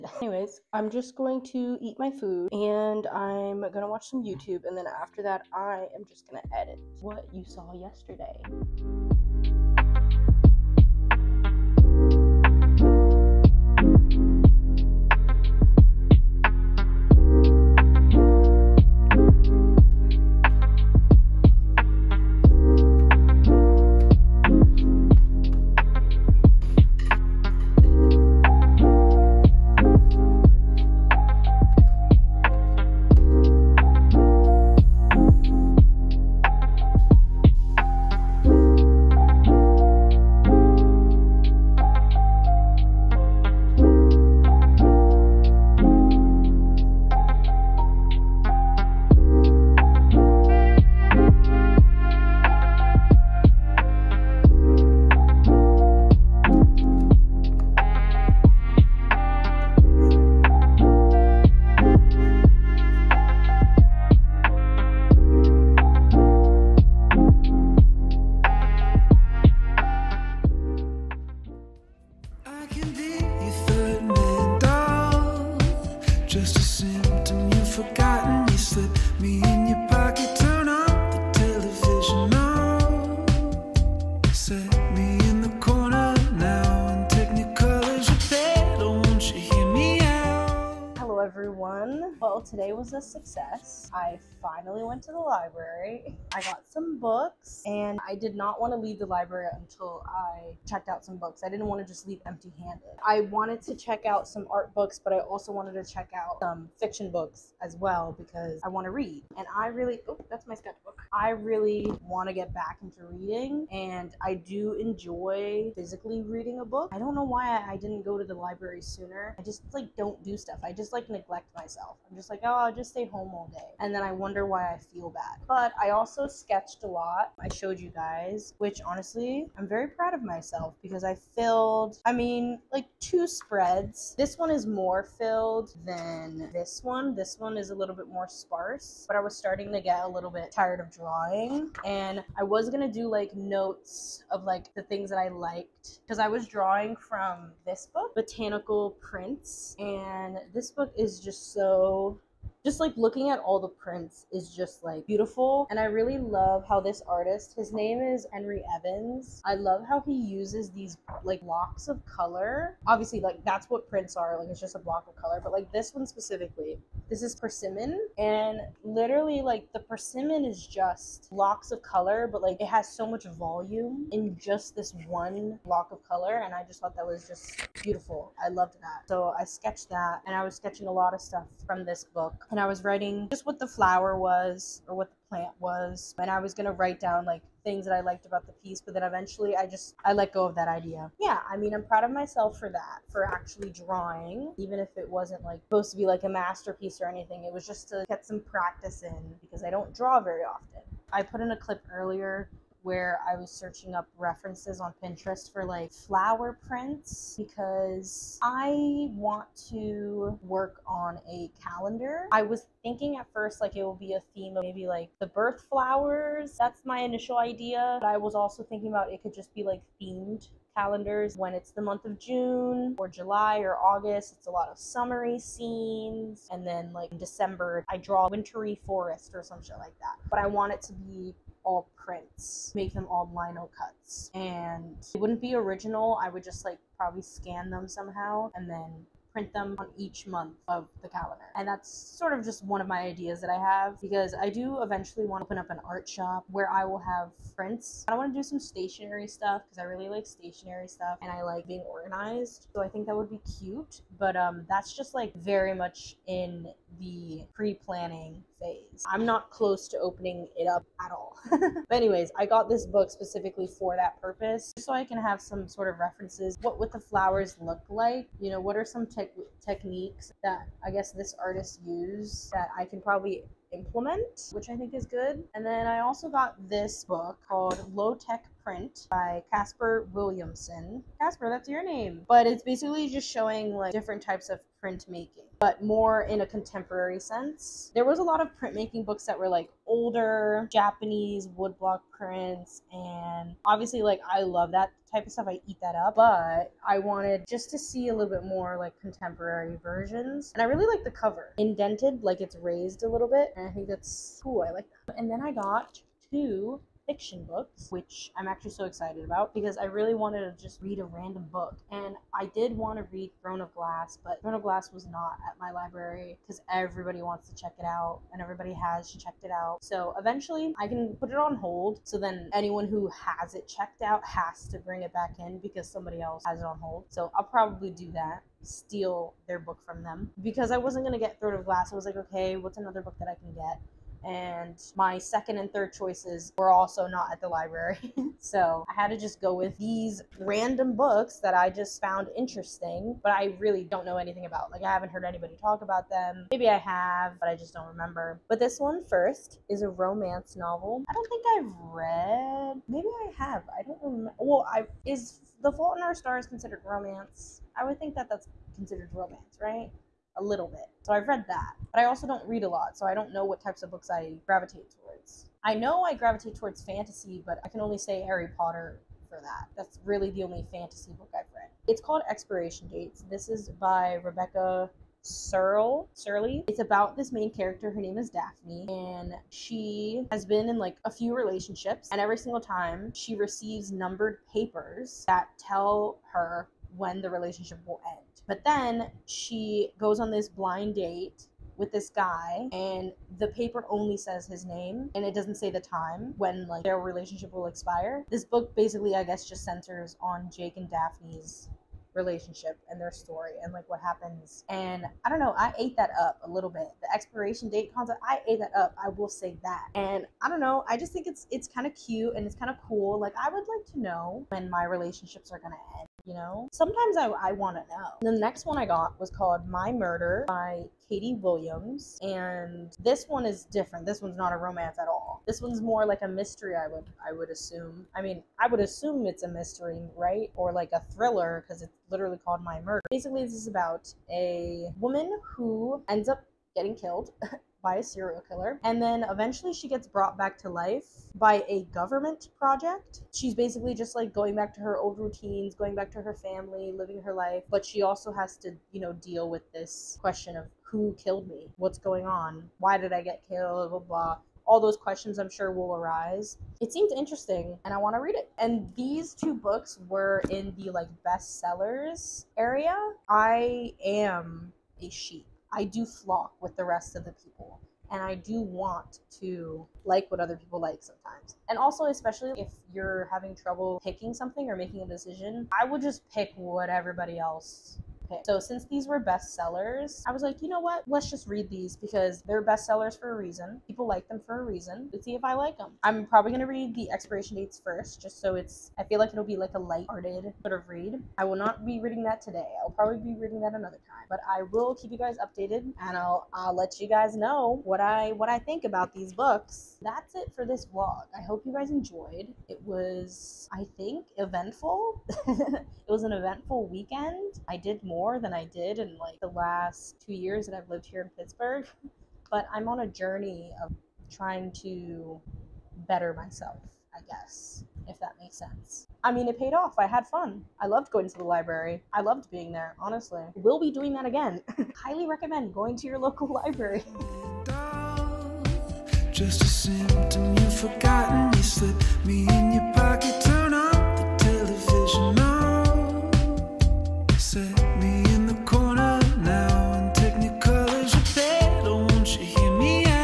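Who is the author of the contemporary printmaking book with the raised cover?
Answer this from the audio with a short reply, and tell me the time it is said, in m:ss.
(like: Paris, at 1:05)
Caspar Williamson, at 4:39.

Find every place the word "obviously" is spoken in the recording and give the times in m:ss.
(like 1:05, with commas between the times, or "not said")
2:42, 4:53.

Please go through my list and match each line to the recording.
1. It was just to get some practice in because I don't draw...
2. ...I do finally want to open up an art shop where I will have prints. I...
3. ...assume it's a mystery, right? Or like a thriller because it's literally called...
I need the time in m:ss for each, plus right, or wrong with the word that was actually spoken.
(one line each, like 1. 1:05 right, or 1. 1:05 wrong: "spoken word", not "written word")
1. 3:17 right
2. 4:04 wrong: "eventually", not "finally"
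3. 7:08 right.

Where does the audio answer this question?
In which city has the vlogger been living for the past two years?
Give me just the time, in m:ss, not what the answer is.
8:31.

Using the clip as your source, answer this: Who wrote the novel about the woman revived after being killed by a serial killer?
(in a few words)
Katie Williams.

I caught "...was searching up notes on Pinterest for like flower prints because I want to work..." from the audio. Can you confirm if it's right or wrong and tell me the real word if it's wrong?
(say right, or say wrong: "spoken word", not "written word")
wrong: "references", not "notes".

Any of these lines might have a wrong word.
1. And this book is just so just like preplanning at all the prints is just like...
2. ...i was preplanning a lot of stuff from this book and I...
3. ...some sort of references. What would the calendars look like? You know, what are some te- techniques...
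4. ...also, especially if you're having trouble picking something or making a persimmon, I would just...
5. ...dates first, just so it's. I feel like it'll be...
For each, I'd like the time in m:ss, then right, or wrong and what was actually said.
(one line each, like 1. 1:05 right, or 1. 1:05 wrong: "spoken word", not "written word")
1. 2:29 wrong: "looking", not "preplanning"
2. 3:00 wrong: "sketching", not "preplanning"
3. 4:25 wrong: "flowers", not "calendars"
4. 7:51 wrong: "decision", not "persimmon"
5. 8:07 right.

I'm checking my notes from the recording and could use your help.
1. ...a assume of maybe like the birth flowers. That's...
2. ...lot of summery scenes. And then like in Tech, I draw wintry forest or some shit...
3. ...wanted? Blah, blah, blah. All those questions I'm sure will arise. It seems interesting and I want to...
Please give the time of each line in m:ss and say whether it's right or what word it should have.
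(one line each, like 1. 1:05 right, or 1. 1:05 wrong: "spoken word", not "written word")
1. 3:34 wrong: "theme", not "assume"
2. 3:44 wrong: "December", not "Tech"
3. 7:33 wrong: "killed", not "wanted".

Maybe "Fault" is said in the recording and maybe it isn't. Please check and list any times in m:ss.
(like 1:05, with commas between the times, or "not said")
5:55.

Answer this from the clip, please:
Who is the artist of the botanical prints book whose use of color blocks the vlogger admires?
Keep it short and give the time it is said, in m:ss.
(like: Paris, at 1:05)
Henry Evans, at 2:38.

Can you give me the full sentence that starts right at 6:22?
And every single time, she receives numbered papers that tell her when the relationship will end.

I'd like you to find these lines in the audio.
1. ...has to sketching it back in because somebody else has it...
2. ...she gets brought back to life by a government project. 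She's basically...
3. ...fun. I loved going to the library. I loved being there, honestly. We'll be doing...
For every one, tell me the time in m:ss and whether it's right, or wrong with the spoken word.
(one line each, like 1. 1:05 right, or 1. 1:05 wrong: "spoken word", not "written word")
1. 5:24 wrong: "bring", not "sketching"
2. 7:19 right
3. 8:40 right.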